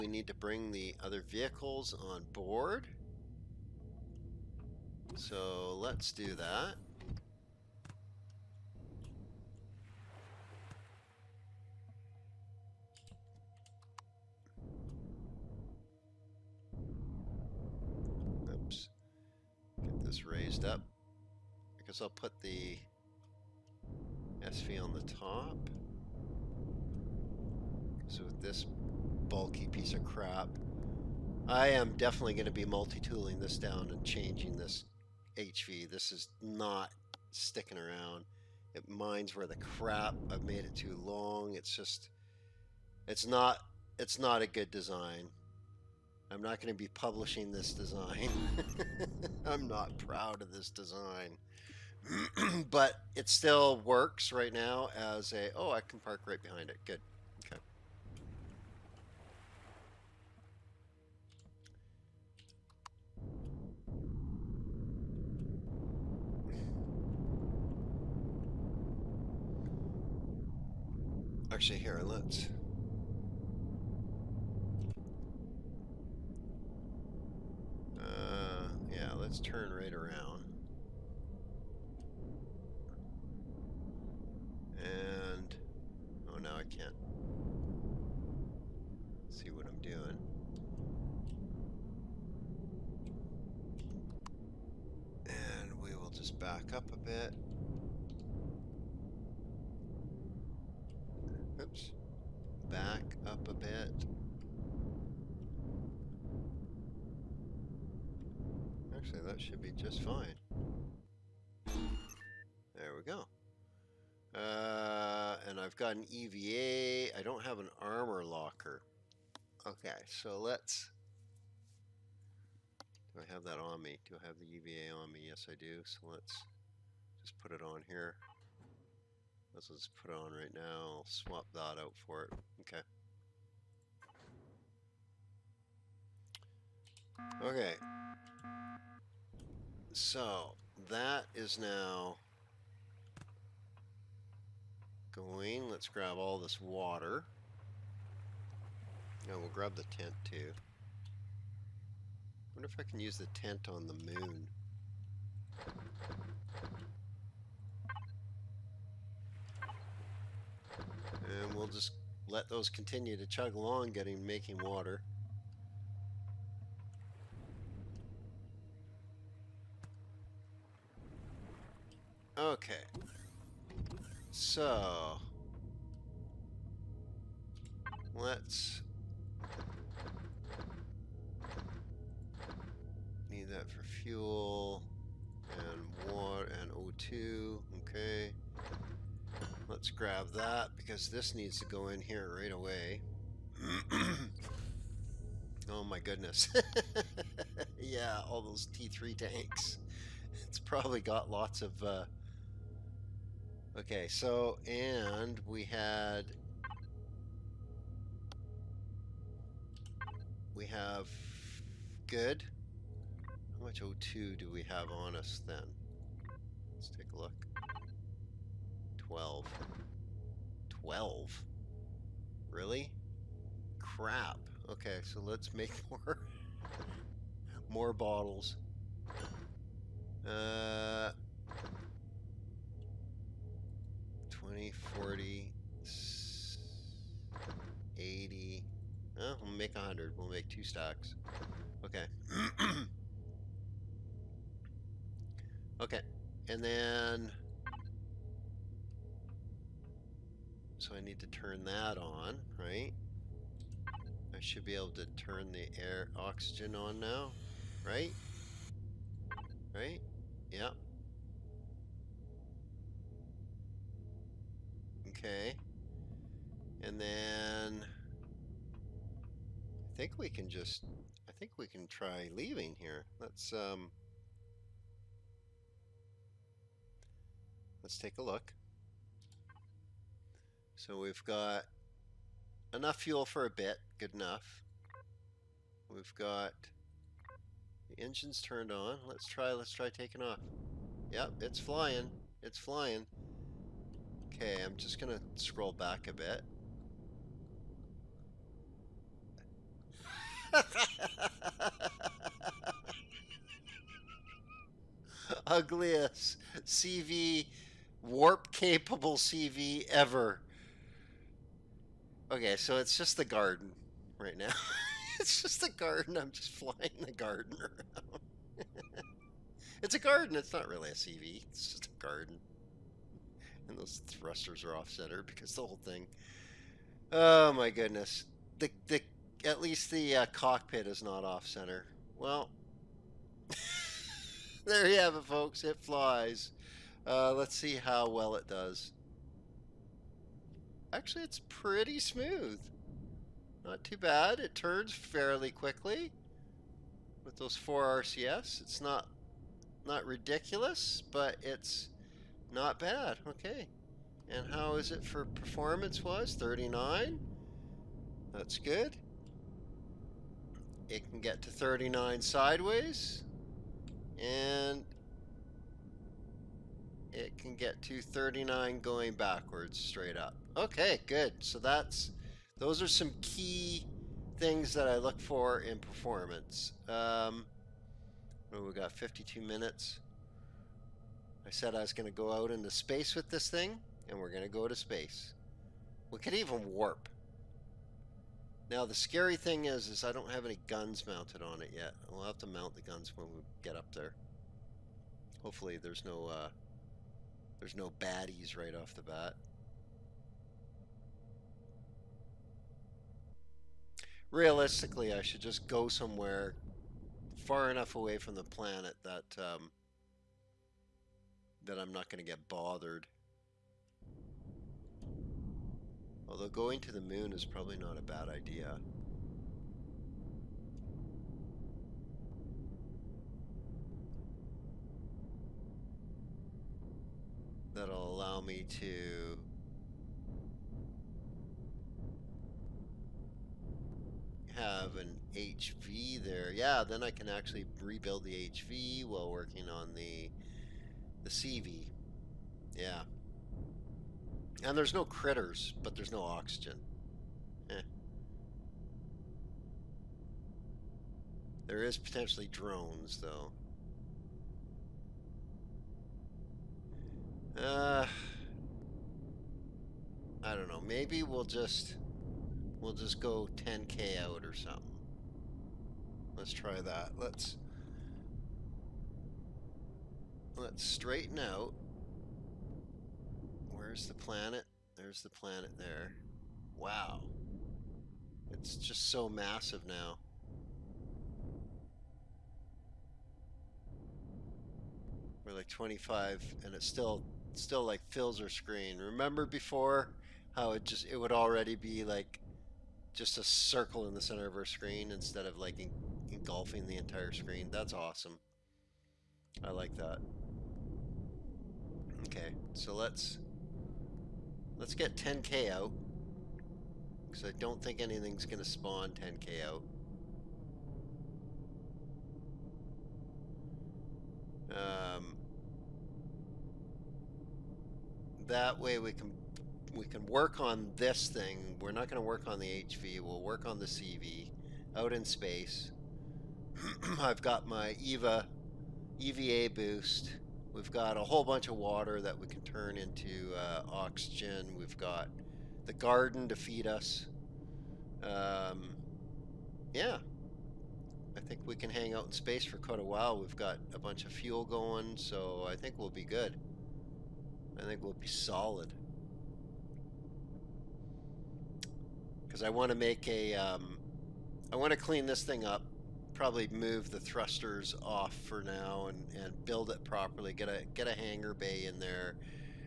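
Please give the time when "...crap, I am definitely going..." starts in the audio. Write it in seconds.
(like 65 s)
30 s.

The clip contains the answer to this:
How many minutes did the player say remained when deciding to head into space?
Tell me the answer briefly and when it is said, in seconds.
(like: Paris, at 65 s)
52, at 378 s.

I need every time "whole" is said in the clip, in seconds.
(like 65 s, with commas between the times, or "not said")
325 s, 531 s.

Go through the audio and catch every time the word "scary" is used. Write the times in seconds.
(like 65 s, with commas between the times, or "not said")
388 s.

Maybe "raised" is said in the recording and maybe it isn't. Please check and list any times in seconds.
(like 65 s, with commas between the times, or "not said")
20 s.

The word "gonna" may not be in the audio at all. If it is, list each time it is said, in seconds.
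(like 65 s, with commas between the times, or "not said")
294 s, 508 s.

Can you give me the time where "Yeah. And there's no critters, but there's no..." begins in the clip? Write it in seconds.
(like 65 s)
442 s.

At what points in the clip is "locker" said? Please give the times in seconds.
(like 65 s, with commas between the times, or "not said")
118 s.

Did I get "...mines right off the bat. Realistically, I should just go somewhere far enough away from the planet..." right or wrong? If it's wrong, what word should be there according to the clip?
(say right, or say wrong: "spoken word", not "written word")
wrong: "baddies", not "mines".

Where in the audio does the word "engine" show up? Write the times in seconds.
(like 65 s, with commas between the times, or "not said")
288 s.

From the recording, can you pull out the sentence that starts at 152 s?
wonder if I can use the tent on the moon.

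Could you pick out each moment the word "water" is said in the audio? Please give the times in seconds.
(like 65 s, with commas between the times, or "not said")
146 s, 164 s, 186 s, 531 s.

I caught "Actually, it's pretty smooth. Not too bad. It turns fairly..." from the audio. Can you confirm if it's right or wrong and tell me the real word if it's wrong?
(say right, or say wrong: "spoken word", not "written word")
right.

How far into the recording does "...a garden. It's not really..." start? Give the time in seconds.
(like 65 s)
319 s.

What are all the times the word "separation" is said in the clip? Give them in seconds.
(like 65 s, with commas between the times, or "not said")
not said.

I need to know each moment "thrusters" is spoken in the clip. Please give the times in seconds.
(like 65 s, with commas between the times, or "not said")
324 s, 557 s.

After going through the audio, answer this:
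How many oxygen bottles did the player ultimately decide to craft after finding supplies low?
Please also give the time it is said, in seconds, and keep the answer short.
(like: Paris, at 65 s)
100, at 239 s.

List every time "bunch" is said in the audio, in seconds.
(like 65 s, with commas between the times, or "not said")
531 s, 543 s.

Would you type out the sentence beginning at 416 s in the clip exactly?
Although going to the moon is probably not a bad idea.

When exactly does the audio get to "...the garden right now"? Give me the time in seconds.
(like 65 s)
313 s.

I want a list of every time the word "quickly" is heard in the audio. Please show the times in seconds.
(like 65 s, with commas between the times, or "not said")
345 s.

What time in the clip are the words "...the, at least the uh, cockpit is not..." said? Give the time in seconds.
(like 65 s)
328 s.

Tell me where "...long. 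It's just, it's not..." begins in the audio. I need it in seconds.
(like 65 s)
41 s.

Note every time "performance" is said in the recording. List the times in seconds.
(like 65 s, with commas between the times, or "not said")
355 s, 375 s.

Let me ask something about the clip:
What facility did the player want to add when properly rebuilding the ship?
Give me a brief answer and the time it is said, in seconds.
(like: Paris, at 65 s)
a hangar bay, at 561 s.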